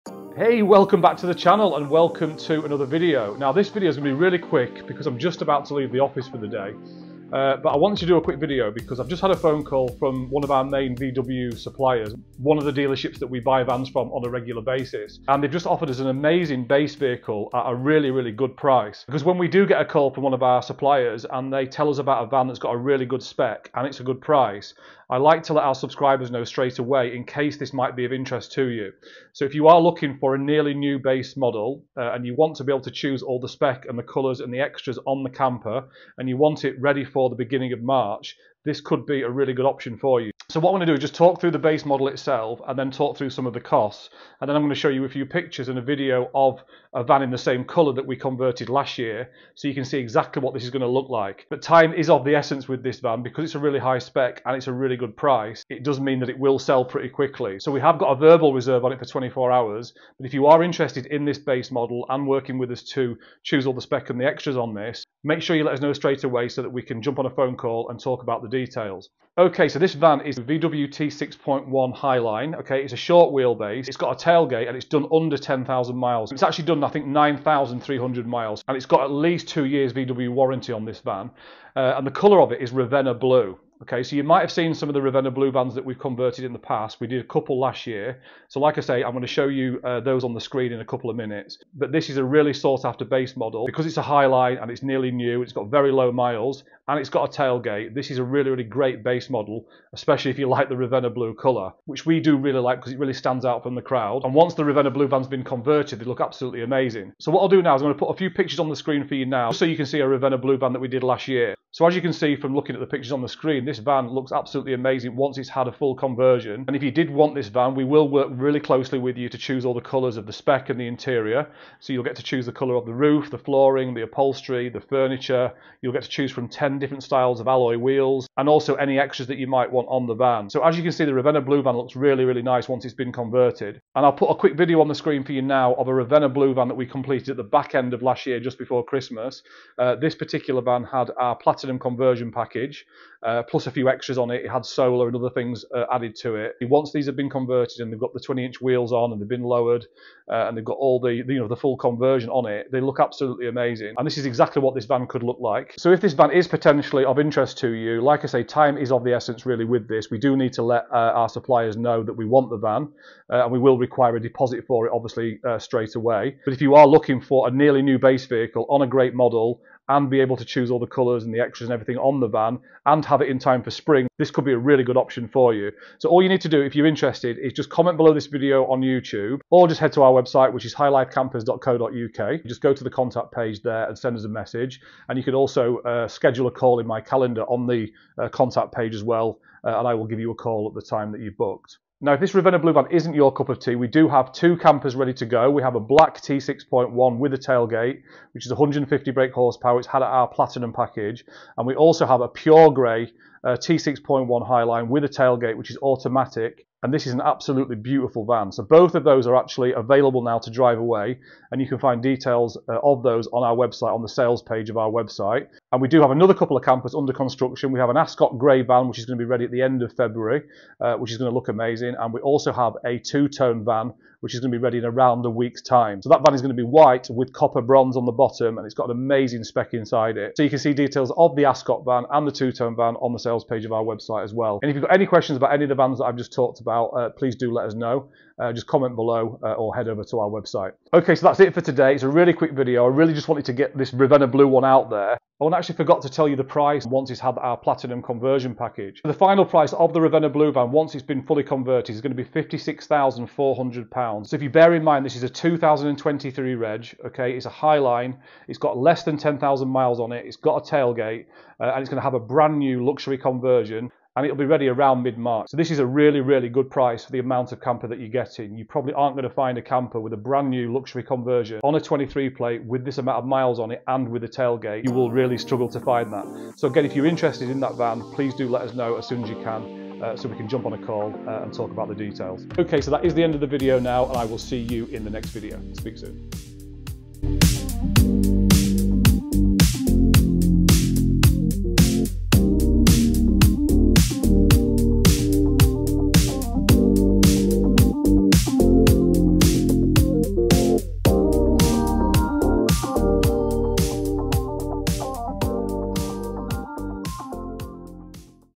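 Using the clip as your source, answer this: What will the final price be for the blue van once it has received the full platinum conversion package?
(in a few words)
£56,400.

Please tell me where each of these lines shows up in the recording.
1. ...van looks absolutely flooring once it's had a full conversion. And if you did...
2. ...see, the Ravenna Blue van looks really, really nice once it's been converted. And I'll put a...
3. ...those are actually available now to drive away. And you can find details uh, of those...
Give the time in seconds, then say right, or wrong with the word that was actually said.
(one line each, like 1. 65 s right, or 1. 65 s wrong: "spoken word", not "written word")
1. 113 s wrong: "amazing", not "flooring"
2. 130 s right
3. 209 s right.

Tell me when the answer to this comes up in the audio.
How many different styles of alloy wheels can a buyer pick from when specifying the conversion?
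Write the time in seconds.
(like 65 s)
126 s.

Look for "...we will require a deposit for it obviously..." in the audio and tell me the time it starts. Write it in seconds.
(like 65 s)
163 s.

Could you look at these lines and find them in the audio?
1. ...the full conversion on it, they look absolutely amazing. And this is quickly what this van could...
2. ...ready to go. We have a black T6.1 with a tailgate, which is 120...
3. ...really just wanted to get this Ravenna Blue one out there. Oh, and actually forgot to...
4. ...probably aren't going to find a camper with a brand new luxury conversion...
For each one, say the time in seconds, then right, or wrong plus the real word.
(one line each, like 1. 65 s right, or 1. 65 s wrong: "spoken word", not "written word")
1. 151 s wrong: "exactly", not "quickly"
2. 194 s wrong: "150", not "120"
3. 242 s right
4. 268 s right.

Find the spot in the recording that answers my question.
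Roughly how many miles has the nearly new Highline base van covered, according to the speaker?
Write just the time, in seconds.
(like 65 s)
77 s.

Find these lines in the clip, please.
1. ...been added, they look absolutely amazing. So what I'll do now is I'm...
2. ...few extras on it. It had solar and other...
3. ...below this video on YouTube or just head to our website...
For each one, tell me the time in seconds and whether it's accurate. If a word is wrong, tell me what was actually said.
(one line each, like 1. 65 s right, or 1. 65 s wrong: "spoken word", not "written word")
1. 105 s wrong: "converted", not "added"
2. 143 s right
3. 177 s right.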